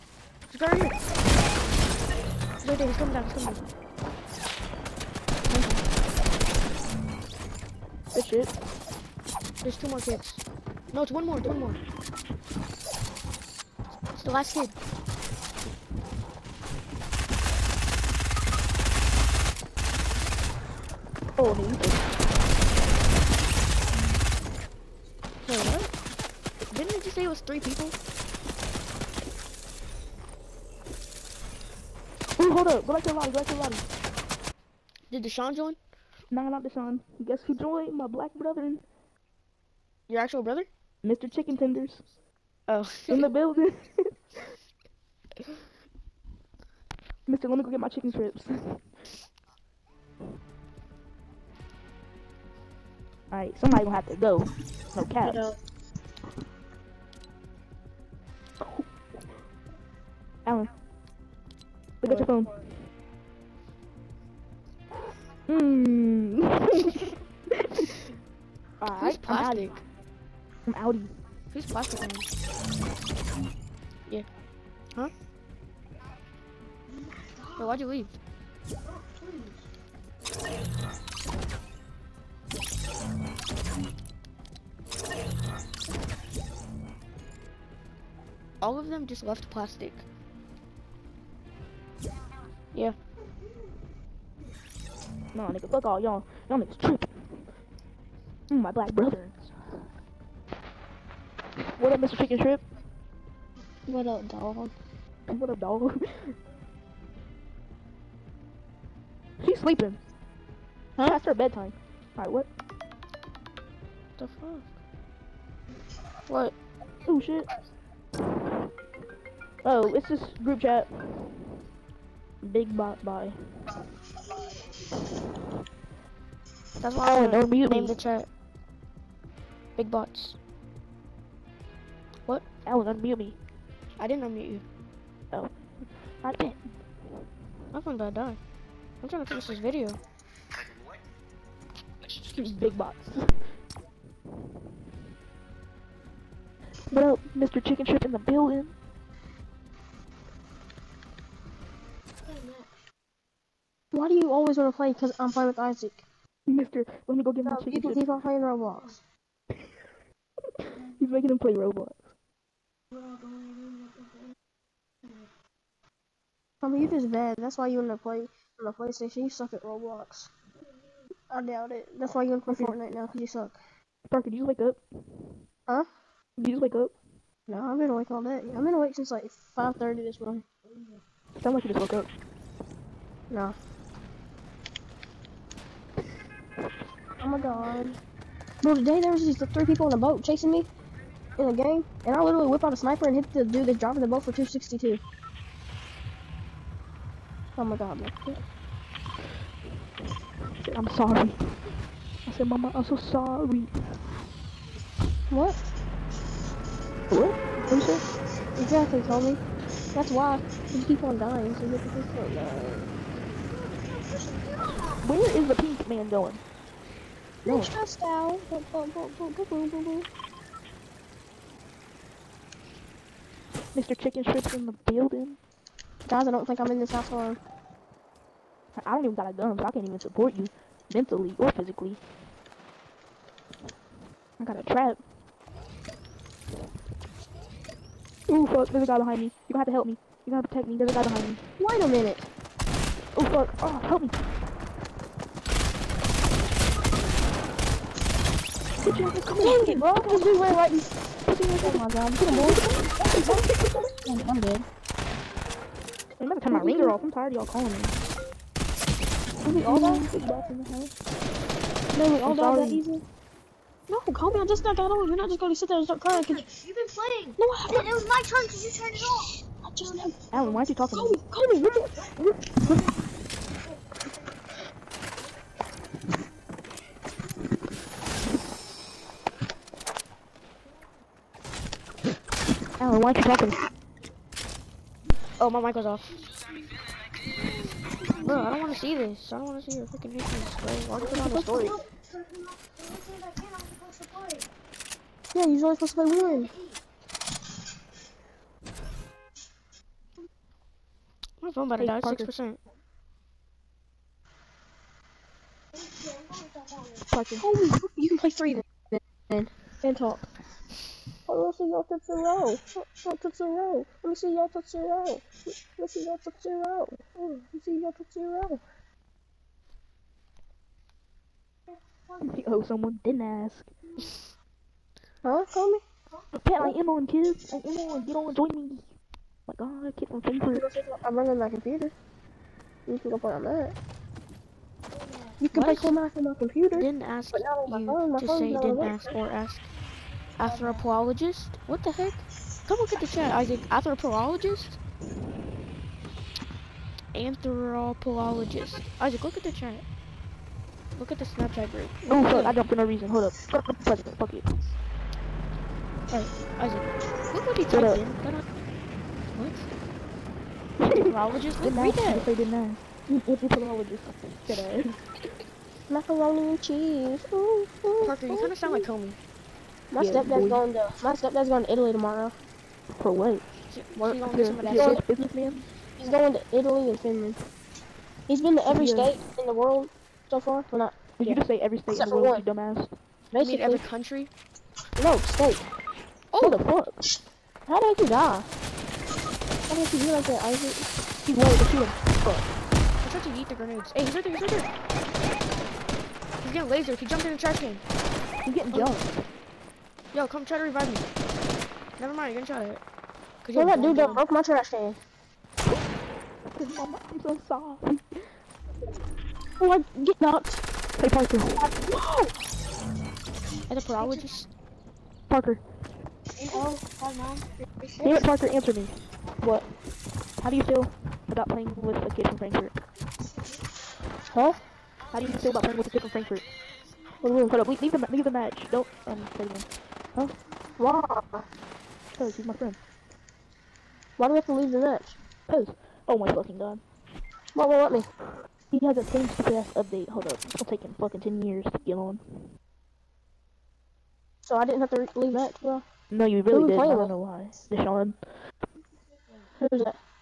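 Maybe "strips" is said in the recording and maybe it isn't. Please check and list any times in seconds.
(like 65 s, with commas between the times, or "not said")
48 s, 224 s.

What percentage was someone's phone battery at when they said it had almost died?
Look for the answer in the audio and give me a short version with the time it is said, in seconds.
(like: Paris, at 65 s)
6%, at 302 s.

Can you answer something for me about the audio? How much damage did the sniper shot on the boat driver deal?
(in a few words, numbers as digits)
262.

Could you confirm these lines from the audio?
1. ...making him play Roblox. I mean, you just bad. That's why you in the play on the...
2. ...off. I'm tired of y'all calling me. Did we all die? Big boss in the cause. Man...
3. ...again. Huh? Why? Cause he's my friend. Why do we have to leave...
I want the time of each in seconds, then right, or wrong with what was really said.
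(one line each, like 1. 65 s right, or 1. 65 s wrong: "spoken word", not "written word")
1. 161 s right
2. 256 s wrong: "house", not "cause"
3. 429 s right.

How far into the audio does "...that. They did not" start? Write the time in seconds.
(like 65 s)
361 s.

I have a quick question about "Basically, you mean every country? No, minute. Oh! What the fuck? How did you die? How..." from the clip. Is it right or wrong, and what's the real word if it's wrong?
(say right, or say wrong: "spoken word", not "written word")
wrong: "state", not "minute".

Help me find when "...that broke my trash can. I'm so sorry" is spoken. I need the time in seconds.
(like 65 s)
403 s.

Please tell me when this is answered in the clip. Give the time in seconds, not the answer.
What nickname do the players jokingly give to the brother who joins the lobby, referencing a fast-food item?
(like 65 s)
41 s.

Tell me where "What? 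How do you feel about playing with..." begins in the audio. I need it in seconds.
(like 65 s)
419 s.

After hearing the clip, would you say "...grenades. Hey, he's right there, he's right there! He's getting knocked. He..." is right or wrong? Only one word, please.
wrong.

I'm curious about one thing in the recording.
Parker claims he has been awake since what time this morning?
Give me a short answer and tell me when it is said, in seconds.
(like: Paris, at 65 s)
5:30, at 179 s.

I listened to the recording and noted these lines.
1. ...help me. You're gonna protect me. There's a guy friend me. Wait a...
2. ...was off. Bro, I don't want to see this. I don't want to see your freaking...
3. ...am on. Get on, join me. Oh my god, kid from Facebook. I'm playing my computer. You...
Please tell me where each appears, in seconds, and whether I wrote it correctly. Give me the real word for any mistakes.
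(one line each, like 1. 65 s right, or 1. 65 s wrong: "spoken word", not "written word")
1. 239 s wrong: "behind", not "friend"
2. 285 s right
3. 327 s wrong: "running", not "playing".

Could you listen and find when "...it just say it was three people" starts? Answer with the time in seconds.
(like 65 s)
26 s.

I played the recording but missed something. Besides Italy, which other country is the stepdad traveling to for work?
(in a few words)
Finland.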